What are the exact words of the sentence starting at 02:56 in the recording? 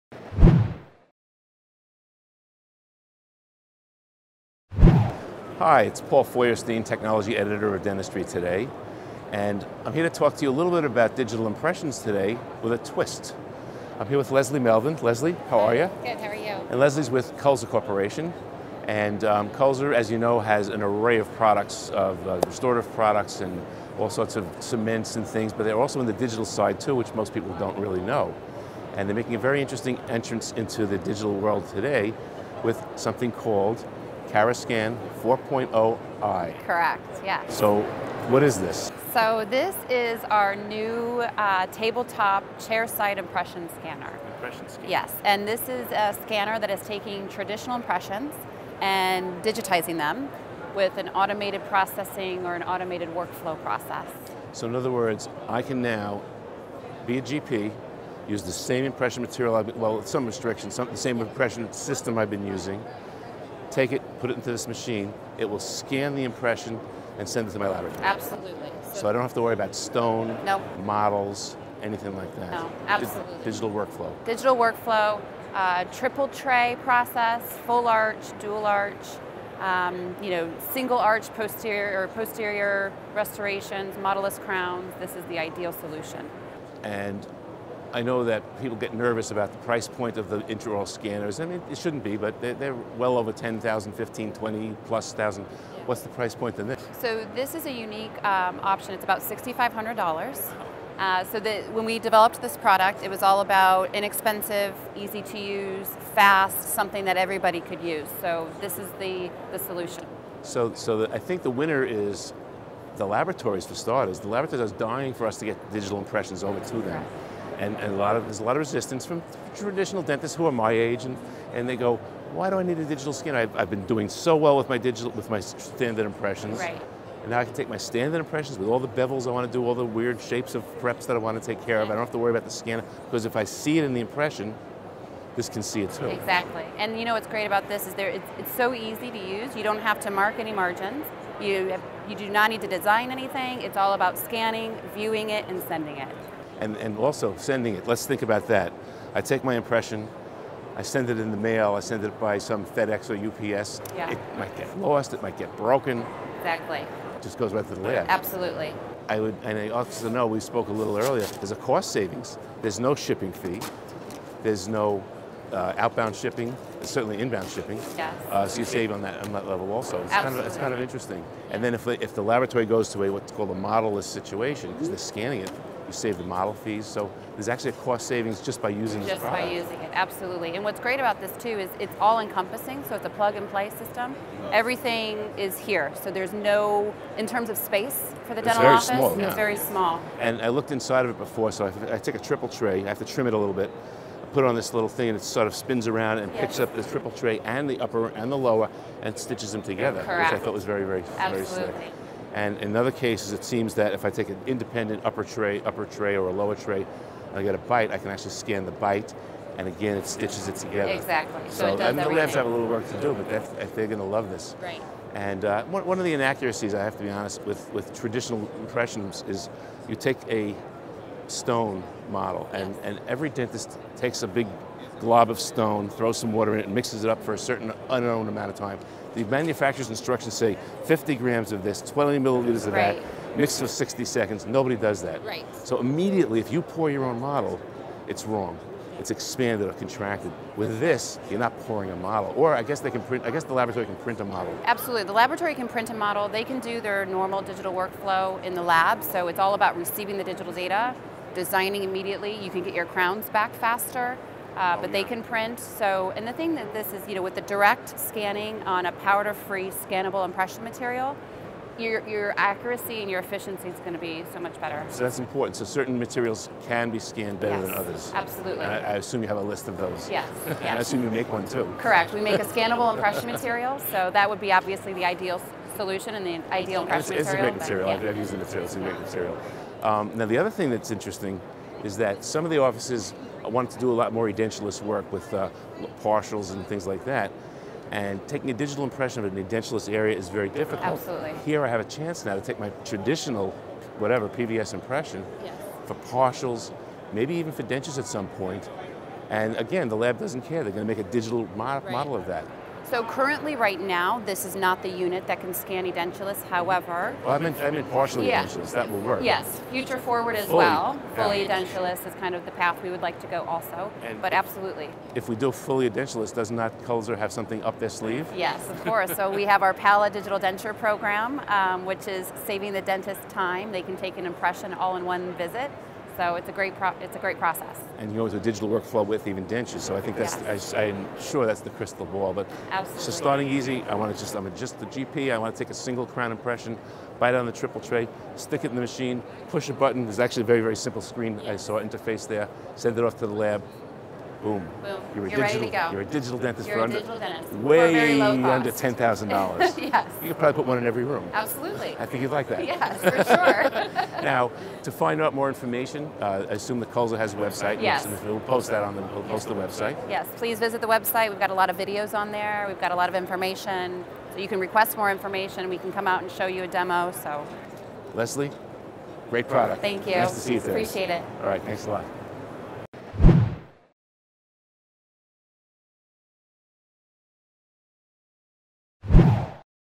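So there's actually a cost savings just by using just this product.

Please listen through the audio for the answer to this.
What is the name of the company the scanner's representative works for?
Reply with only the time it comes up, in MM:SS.
00:17.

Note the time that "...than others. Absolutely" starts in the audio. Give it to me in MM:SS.
04:27.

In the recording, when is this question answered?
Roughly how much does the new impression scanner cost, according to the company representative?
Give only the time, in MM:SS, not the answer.
01:39.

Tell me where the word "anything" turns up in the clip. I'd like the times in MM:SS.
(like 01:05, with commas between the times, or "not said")
01:11, 02:23.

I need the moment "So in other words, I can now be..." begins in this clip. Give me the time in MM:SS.
00:54.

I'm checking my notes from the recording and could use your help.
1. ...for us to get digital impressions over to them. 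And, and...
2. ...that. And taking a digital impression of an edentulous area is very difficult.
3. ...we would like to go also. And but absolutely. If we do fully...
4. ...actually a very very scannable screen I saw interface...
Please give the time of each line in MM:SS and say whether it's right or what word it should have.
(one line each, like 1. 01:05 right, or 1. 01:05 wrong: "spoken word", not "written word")
1. 01:55 right
2. 04:47 right
3. 05:12 right
4. 05:40 wrong: "simple", not "scannable".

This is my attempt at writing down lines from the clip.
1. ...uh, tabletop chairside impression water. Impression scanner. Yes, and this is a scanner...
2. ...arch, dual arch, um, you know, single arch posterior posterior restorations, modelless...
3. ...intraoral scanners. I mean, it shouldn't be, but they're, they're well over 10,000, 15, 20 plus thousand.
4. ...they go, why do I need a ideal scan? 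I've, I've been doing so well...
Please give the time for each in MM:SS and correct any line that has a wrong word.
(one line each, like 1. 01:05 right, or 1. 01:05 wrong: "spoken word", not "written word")
1. 00:41 wrong: "scanner", not "water"
2. 01:17 right
3. 01:30 right
4. 02:01 wrong: "digital", not "ideal".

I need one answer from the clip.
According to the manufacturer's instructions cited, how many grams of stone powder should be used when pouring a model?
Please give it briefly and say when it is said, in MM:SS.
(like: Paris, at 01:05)
50 grams, at 03:50.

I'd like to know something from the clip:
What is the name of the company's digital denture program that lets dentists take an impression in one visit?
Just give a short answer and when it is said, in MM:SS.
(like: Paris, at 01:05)
Pala Digital Denture, at 05:19.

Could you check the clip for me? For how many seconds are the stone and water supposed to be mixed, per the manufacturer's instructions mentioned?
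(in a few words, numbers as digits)
60 seconds.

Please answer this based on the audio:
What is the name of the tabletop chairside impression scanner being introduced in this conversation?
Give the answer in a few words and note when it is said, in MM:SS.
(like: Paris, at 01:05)
cara Scan 4.0i, at 00:34.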